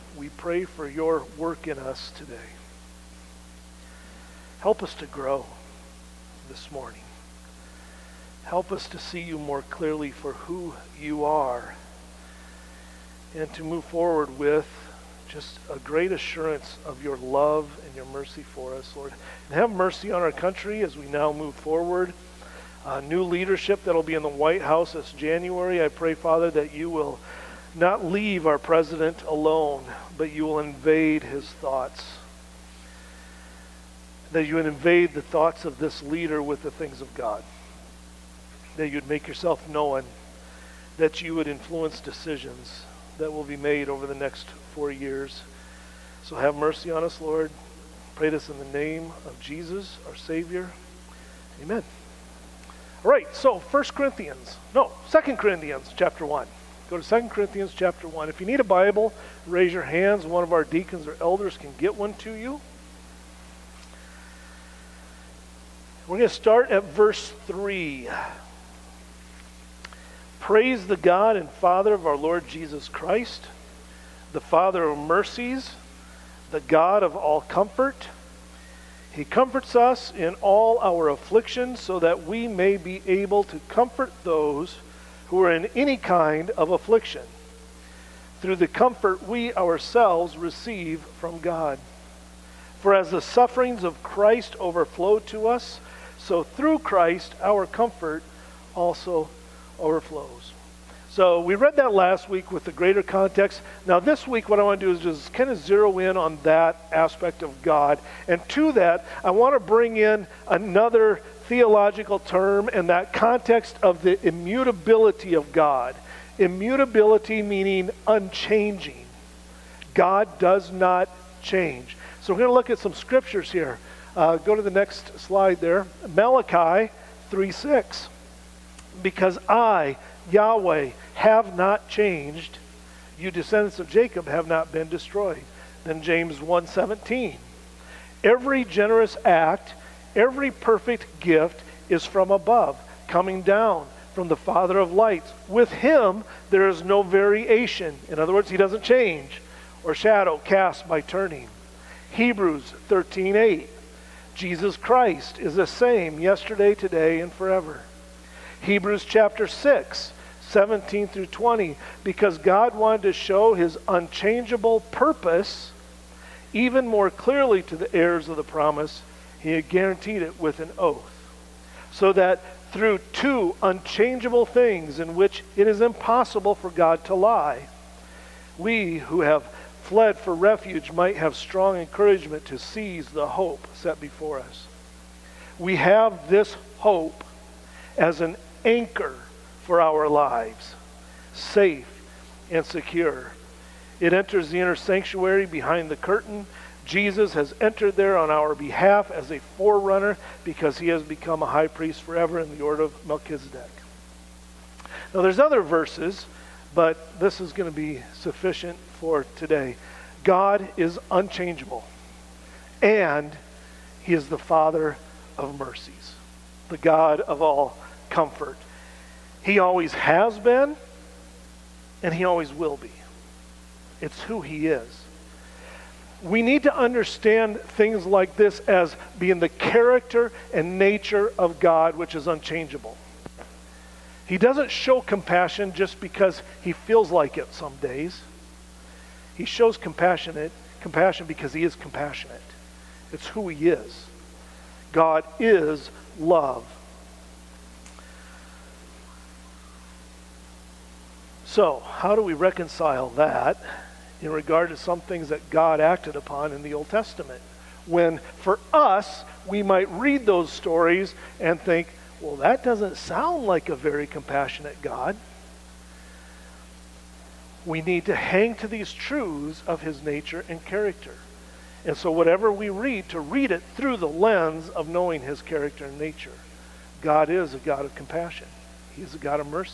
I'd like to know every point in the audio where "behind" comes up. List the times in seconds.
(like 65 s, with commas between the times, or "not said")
195 s.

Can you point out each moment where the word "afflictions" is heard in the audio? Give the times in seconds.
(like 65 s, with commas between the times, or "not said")
81 s, 86 s.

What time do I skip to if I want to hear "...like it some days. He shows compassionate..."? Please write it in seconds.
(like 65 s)
237 s.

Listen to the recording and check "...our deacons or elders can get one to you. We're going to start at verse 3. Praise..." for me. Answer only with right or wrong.
right.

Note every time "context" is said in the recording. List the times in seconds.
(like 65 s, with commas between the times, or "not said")
103 s, 113 s.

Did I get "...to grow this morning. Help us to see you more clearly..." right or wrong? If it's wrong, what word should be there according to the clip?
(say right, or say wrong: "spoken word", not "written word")
right.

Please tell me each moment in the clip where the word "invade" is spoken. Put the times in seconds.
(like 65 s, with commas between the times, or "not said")
30 s, 34 s.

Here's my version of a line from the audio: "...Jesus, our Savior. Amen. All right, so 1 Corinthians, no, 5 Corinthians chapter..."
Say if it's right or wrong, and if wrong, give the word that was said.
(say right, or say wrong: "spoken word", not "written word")
wrong: "2", not "5".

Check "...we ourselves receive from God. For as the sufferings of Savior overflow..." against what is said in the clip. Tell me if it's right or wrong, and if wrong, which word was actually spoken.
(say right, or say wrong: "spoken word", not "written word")
wrong: "Christ", not "Savior".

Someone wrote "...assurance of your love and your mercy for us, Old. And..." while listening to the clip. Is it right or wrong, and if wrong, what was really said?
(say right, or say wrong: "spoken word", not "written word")
wrong: "Lord", not "Old".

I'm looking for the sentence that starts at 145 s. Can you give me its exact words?
With him there is no variation.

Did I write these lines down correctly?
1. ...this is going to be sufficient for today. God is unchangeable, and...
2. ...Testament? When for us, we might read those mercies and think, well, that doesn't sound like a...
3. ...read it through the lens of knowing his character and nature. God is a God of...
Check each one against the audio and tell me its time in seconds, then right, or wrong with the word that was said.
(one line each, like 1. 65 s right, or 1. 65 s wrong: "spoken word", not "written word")
1. 207 s right
2. 256 s wrong: "stories", not "mercies"
3. 273 s right.